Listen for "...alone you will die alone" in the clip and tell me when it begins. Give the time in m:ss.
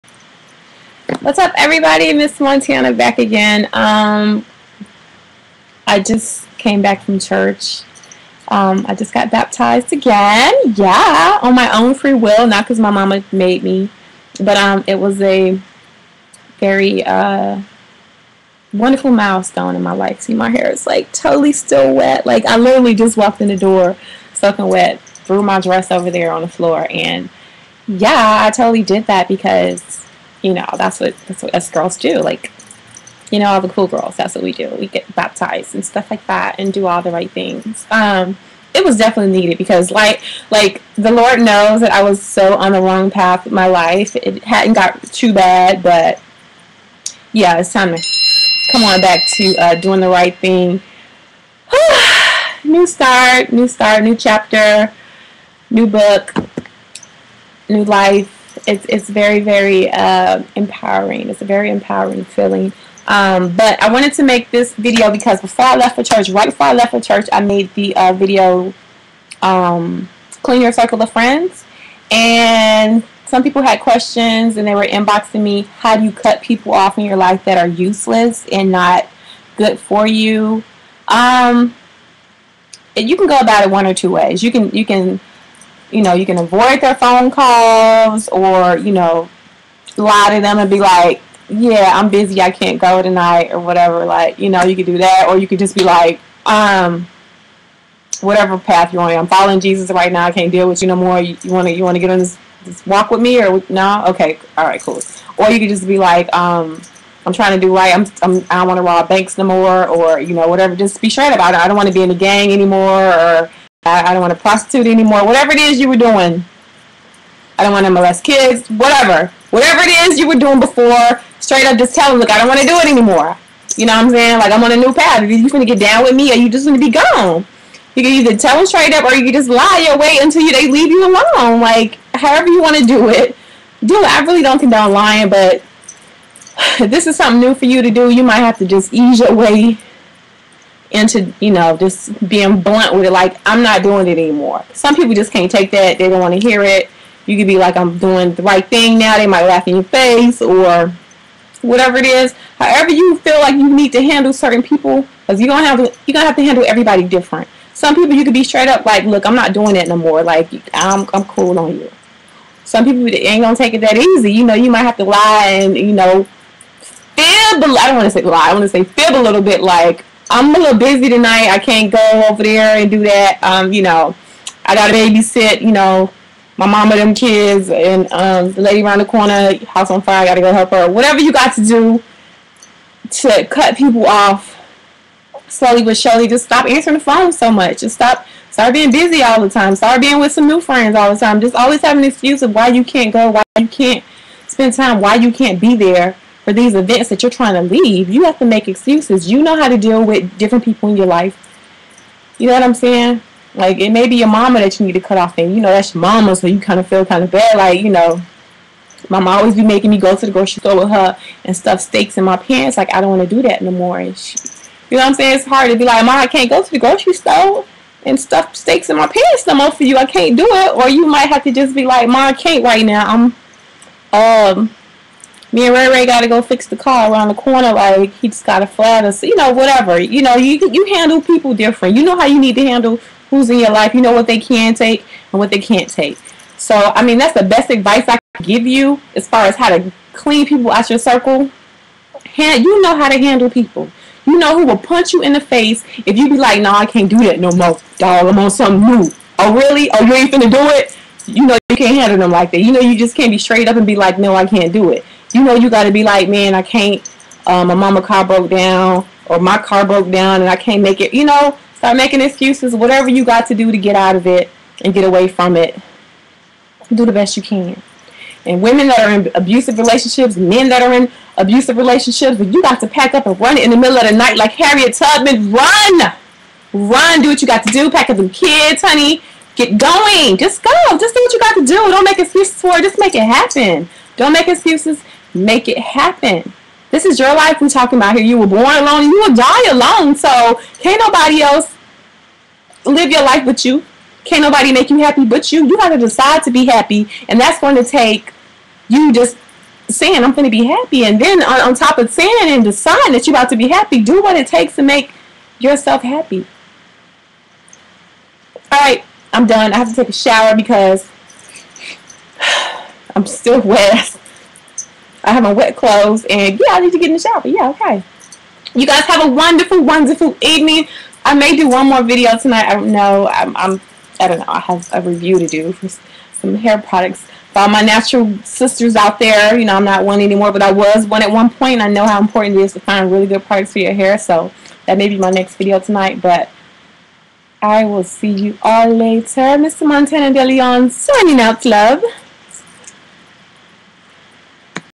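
4:48.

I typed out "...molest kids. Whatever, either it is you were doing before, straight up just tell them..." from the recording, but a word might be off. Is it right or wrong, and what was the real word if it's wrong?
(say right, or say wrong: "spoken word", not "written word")
wrong: "whatever", not "either".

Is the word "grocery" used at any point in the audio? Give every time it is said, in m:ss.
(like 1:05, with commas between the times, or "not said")
3:30, 3:36.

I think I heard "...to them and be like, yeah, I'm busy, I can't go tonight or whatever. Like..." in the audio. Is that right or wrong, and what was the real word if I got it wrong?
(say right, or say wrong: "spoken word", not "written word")
right.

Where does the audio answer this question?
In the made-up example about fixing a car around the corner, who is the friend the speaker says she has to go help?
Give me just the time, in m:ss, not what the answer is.
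3:45.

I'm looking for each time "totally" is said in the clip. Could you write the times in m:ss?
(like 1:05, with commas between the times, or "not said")
0:21, 0:28.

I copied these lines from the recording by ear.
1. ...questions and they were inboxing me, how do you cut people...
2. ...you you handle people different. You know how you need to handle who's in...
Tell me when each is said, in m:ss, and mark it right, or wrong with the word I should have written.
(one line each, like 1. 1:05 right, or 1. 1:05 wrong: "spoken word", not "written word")
1. 1:13 right
2. 3:50 right.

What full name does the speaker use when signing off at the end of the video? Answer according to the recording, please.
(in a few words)
Montana De Leon.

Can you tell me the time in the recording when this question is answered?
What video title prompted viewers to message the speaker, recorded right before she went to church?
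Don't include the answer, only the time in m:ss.
1:10.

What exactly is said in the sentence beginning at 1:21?
Um, you can go about it one or two ways.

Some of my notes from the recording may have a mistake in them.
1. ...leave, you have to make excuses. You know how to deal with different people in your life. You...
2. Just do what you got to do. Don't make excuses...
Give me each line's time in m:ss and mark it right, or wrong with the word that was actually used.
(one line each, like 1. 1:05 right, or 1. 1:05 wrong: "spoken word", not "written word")
1. 3:17 right
2. 4:40 right.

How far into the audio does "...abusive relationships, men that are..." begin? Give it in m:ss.
4:29.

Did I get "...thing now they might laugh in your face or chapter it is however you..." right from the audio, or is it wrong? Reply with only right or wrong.
wrong.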